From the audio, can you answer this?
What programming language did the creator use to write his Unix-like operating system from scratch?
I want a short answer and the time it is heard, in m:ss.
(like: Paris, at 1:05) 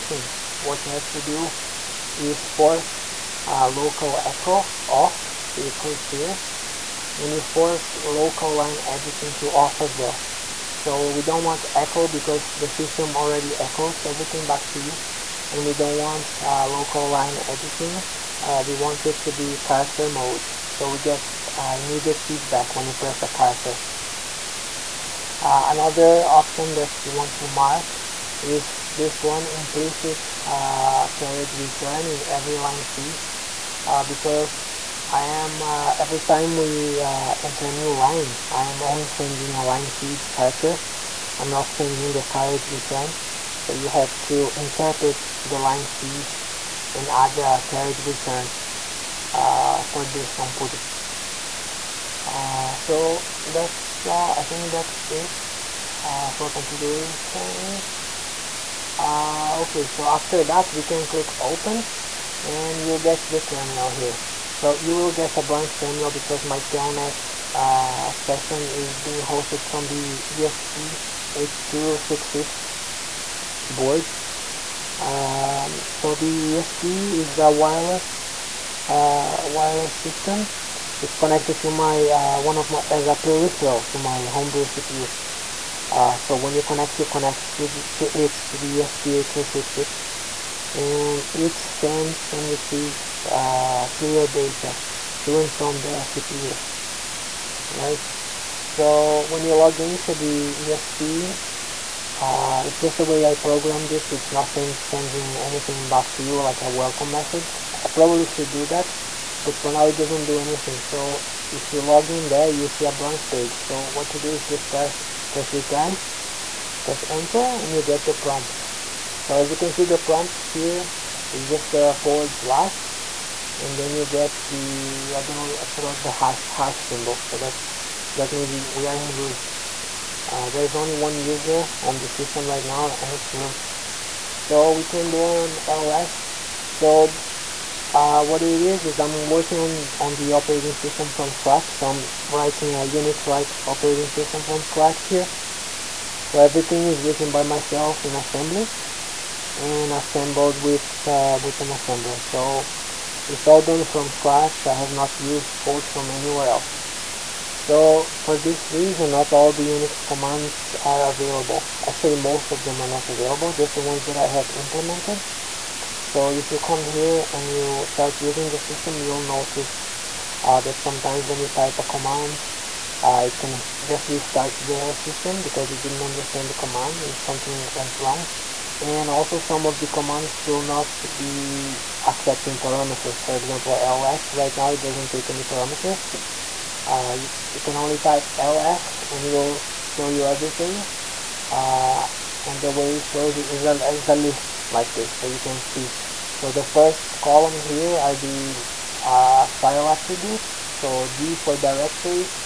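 assembly, at 2:28.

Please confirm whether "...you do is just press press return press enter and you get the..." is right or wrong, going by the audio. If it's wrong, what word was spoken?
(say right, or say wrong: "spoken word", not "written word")
right.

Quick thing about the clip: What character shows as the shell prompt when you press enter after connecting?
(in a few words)
forward slash.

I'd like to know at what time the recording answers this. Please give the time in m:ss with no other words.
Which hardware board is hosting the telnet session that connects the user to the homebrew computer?
1:10.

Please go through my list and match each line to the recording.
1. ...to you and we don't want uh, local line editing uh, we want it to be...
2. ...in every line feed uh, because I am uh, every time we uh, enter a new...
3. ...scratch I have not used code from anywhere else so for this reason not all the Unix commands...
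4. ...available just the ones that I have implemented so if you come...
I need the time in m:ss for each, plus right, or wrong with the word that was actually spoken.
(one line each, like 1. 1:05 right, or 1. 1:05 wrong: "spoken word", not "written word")
1. 0:14 right
2. 0:32 right
3. 2:34 right
4. 2:43 right.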